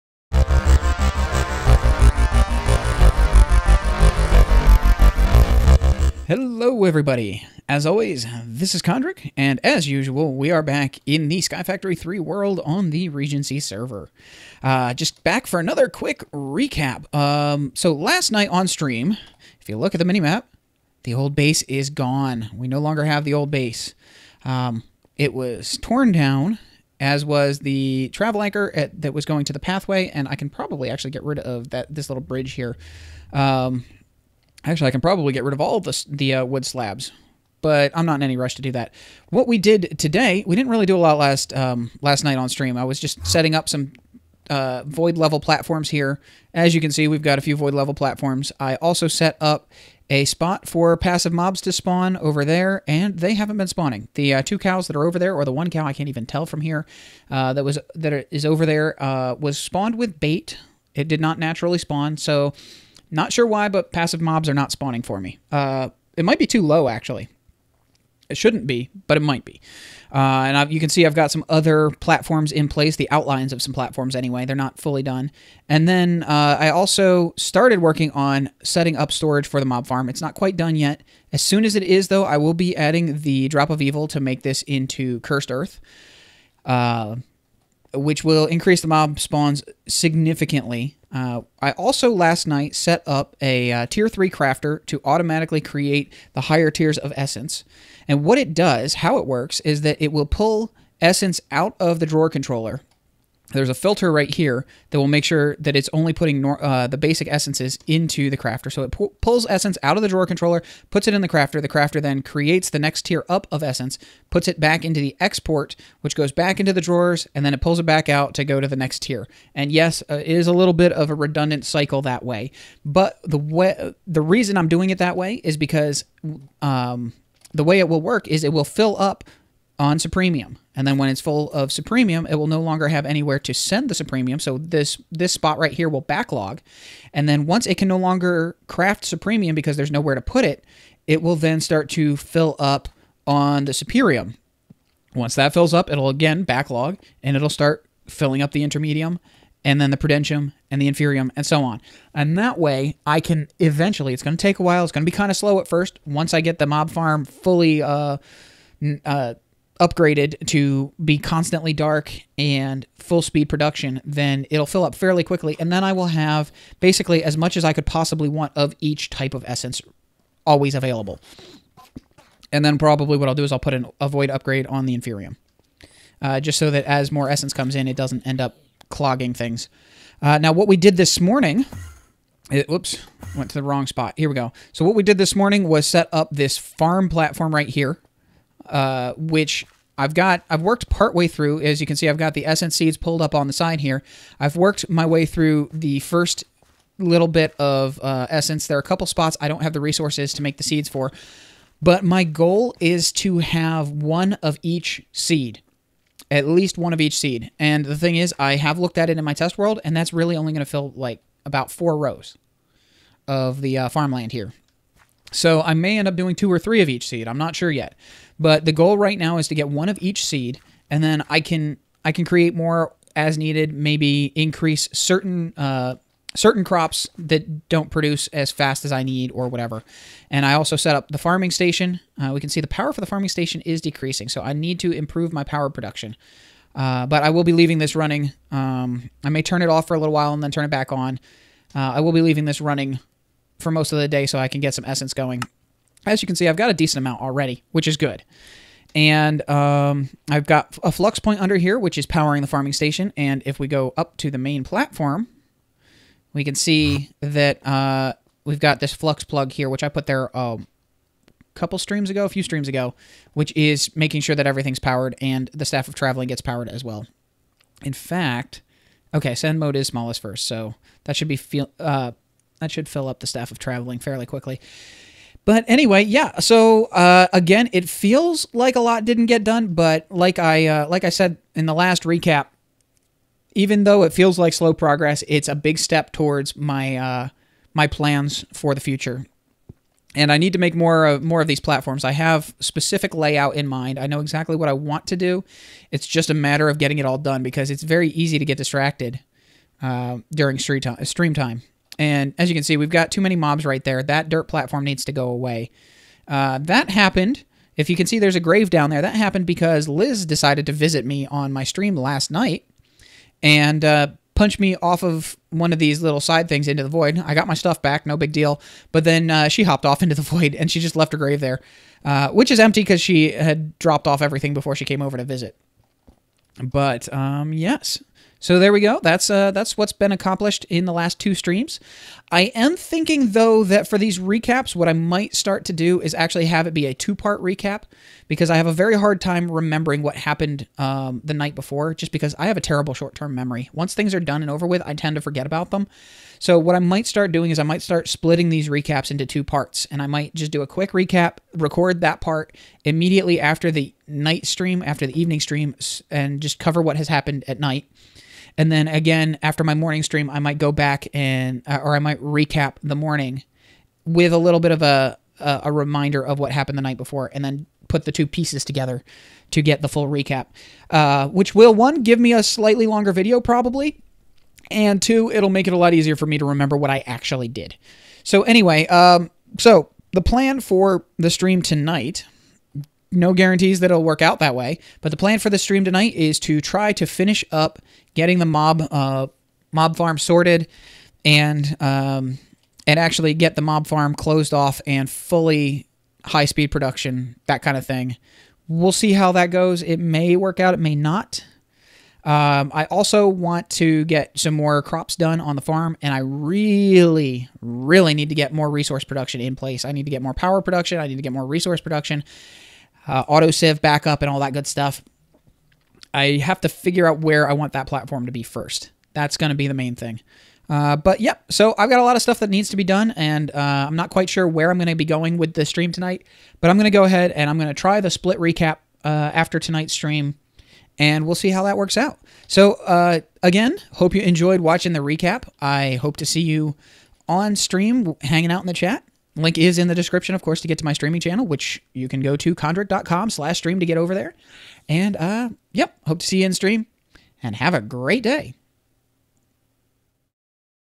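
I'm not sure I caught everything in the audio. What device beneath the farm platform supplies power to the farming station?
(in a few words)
flux point.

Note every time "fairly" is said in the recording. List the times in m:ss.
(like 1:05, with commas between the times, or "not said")
2:44, 4:33.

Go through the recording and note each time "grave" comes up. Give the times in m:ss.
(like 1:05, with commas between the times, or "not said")
5:08, 5:21.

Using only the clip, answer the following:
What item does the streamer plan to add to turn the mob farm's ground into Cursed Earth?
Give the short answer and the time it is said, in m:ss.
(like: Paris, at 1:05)
Drop of Evil, at 1:23.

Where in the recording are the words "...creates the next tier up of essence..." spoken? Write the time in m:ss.
1:52.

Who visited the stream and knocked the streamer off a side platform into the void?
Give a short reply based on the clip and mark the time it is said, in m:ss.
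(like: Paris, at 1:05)
Liz, at 5:09.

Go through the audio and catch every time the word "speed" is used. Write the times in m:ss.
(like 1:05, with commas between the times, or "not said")
2:43, 6:36.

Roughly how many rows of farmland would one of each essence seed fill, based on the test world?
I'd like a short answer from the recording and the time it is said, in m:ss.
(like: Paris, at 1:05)
4, at 3:31.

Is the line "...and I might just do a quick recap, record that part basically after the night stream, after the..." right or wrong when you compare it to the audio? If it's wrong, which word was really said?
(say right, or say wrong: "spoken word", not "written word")
wrong: "immediately", not "basically".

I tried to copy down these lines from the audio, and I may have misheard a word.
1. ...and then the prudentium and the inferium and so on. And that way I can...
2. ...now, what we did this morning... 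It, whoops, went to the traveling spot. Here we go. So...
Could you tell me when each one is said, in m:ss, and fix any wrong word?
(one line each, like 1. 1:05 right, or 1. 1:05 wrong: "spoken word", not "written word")
1. 2:29 right
2. 3:00 wrong: "wrong", not "traveling".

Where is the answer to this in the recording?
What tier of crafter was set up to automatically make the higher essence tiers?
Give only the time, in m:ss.
1:33.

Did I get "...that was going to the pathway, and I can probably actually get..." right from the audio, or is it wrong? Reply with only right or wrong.
right.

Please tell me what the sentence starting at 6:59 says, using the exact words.
That's going to be the main thing.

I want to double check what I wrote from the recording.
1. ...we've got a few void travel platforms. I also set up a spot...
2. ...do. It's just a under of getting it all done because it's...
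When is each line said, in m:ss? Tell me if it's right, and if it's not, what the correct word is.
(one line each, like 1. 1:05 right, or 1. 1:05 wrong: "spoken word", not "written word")
1. 0:47 wrong: "level", not "travel"
2. 4:55 wrong: "matter", not "under".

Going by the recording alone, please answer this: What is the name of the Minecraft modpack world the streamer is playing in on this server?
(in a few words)
Sky Factory 3.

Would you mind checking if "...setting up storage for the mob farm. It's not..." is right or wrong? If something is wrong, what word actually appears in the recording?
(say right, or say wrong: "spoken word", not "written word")
right.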